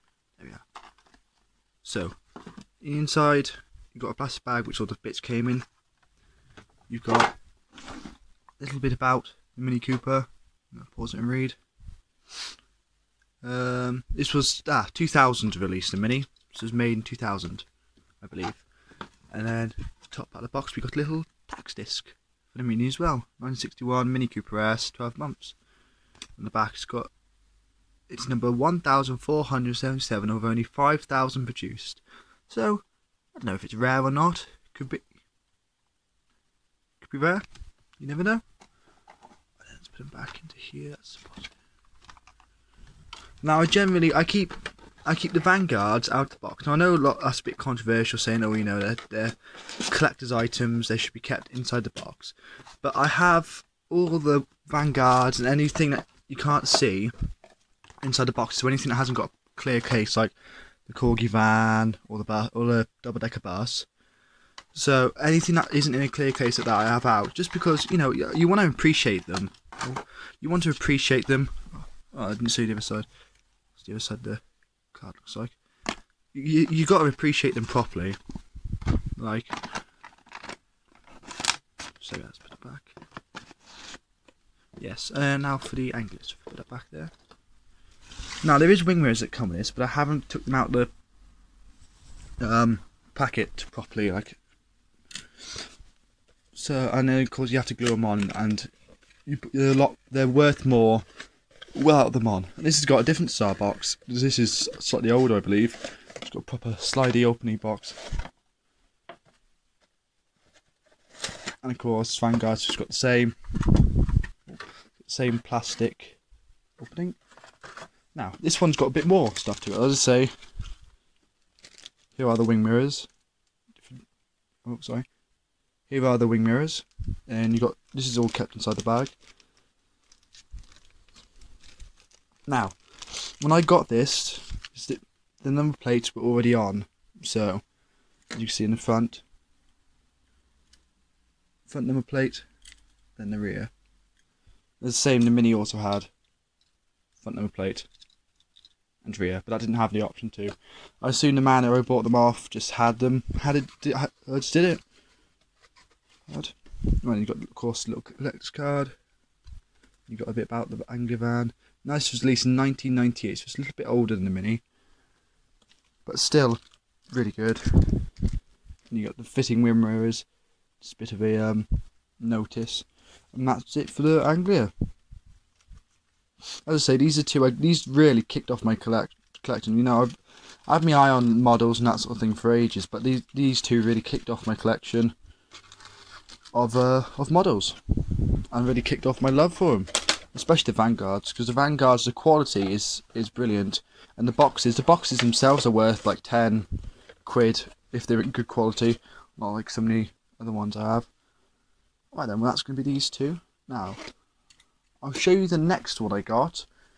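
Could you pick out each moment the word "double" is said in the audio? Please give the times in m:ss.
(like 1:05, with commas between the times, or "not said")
1:03.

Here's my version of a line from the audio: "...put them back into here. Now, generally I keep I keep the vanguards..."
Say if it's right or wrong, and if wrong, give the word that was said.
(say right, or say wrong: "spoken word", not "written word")
right.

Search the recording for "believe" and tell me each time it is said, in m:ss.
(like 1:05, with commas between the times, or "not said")
0:18, 1:45.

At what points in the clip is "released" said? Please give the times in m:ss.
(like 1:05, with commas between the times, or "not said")
0:15, 2:42.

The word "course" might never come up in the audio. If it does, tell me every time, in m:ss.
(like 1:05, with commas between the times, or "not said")
1:37, 1:51, 2:37.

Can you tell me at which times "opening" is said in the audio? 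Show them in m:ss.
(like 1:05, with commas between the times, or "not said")
1:47, 1:56.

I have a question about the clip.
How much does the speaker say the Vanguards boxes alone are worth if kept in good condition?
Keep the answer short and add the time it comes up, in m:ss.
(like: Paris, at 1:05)
10 quid, at 3:16.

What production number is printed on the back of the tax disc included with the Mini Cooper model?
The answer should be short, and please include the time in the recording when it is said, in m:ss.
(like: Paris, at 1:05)
1,477, at 0:28.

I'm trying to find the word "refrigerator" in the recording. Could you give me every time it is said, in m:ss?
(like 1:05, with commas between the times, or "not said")
not said.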